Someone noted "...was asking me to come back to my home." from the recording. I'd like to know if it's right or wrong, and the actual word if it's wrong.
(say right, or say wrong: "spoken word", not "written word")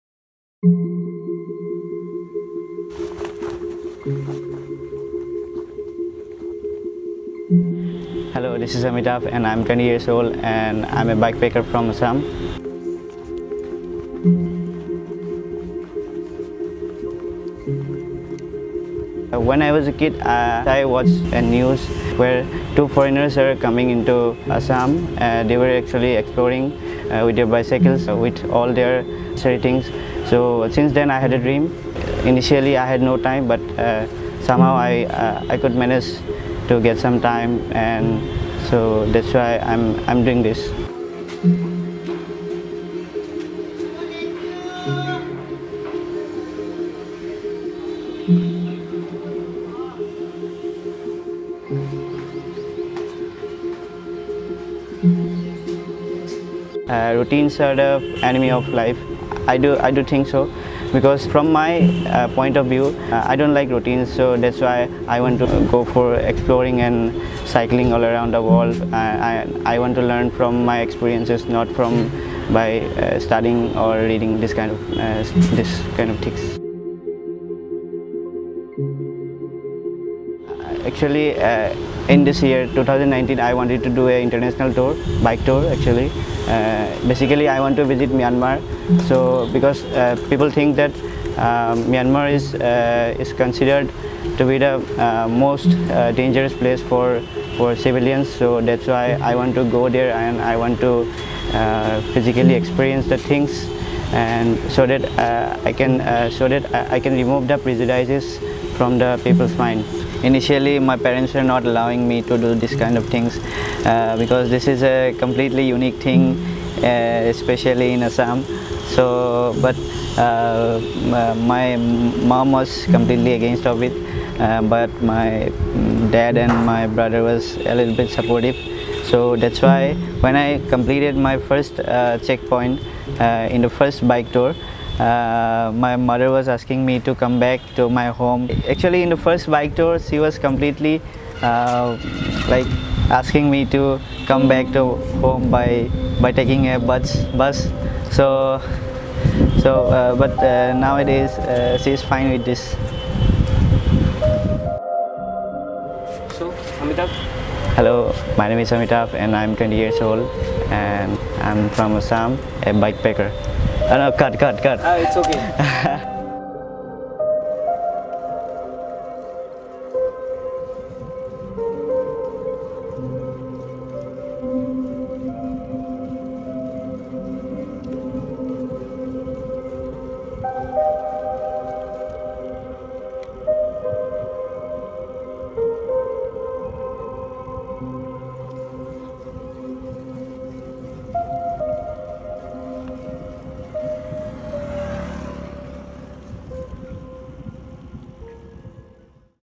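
right.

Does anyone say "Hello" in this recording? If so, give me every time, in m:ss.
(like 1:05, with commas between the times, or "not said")
0:08, 2:37.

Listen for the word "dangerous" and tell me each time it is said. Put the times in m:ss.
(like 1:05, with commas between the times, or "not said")
1:36.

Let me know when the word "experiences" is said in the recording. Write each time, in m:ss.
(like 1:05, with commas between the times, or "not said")
1:10, 1:42.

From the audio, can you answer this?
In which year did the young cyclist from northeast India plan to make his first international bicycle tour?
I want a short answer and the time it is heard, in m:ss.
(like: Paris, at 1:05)
2019, at 1:22.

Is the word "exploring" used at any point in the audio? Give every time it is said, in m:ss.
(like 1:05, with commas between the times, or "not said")
0:26, 1:06.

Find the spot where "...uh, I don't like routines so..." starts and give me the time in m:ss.
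1:03.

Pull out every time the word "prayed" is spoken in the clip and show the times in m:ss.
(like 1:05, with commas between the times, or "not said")
not said.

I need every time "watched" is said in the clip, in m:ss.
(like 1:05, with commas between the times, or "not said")
0:20.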